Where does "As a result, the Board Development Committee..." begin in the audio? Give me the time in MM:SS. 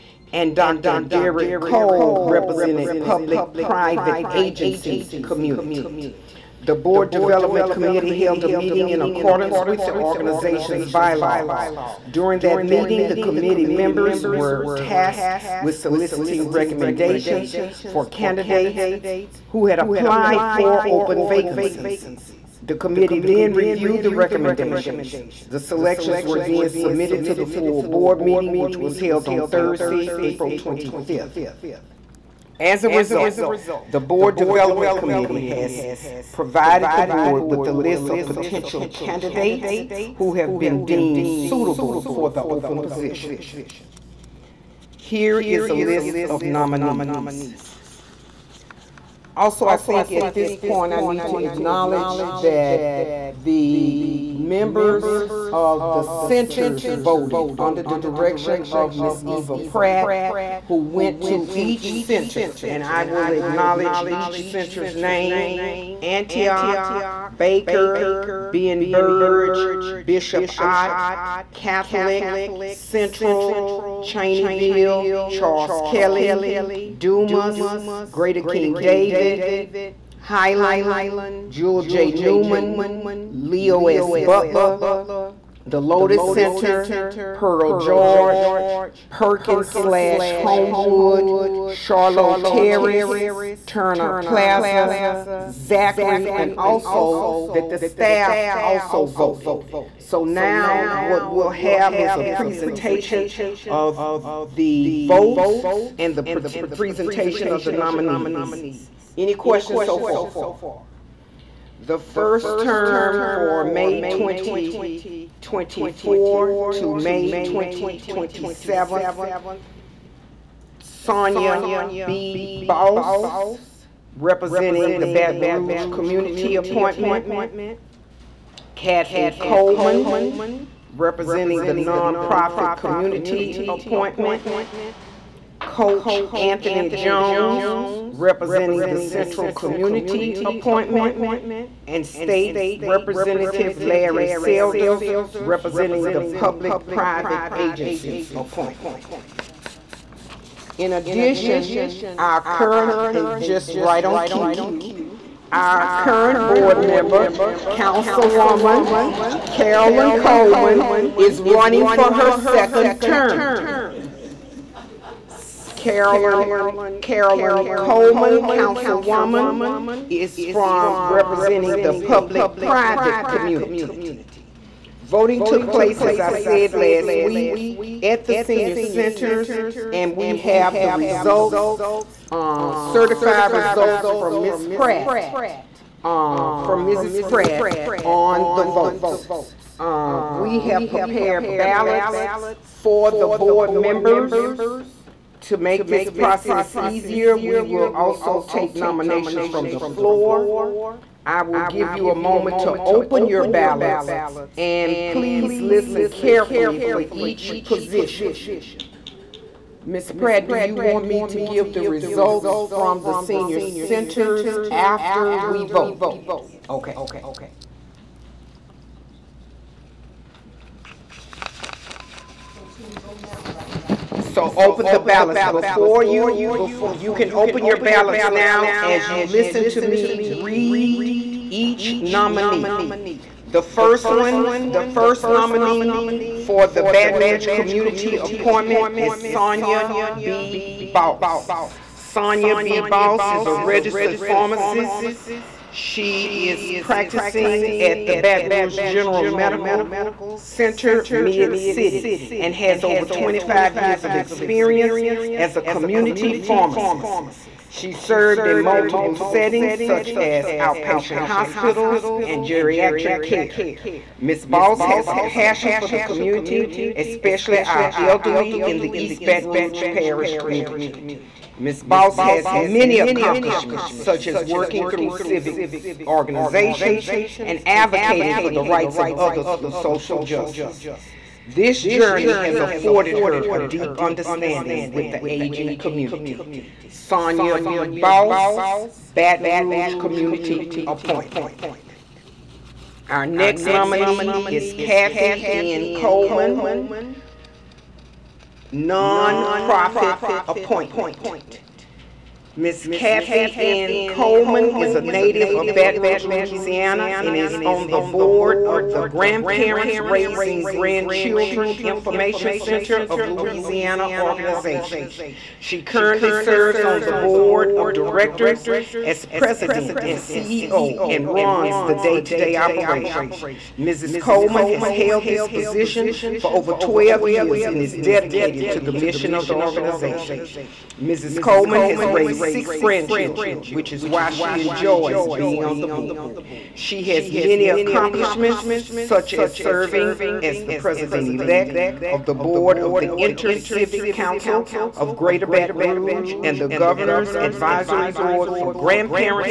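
00:32.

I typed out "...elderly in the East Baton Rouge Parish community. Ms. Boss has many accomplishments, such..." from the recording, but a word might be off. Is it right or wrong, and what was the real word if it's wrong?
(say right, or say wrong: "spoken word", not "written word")
right.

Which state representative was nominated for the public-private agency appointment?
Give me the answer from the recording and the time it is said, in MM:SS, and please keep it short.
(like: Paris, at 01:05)
Larry Selders, at 02:23.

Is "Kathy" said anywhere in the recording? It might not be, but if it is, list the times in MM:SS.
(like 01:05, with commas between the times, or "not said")
02:08, 04:54, 05:02.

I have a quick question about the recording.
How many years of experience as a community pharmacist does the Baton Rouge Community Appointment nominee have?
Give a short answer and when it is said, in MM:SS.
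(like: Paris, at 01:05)
over 25 years, at 04:12.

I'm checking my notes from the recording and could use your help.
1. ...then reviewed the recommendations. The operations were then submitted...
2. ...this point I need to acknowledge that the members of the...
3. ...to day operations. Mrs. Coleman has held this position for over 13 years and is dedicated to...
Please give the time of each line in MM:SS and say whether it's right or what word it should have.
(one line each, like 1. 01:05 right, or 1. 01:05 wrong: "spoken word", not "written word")
1. 00:23 wrong: "selections", not "operations"
2. 00:50 right
3. 05:22 wrong: "12", not "13".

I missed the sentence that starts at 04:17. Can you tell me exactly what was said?
She served in multiple settings such as outpatient hospitals and geriatric care.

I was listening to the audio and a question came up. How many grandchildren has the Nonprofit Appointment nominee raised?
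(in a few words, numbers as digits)
6.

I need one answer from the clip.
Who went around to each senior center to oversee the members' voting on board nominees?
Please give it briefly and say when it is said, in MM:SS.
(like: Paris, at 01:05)
Eva Pratt, at 00:58.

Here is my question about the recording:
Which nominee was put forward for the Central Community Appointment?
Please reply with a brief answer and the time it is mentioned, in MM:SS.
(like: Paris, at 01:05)
Anthony Jones, at 02:15.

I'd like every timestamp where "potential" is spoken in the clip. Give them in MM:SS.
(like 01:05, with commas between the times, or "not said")
00:38.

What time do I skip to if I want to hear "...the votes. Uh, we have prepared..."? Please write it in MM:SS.
03:08.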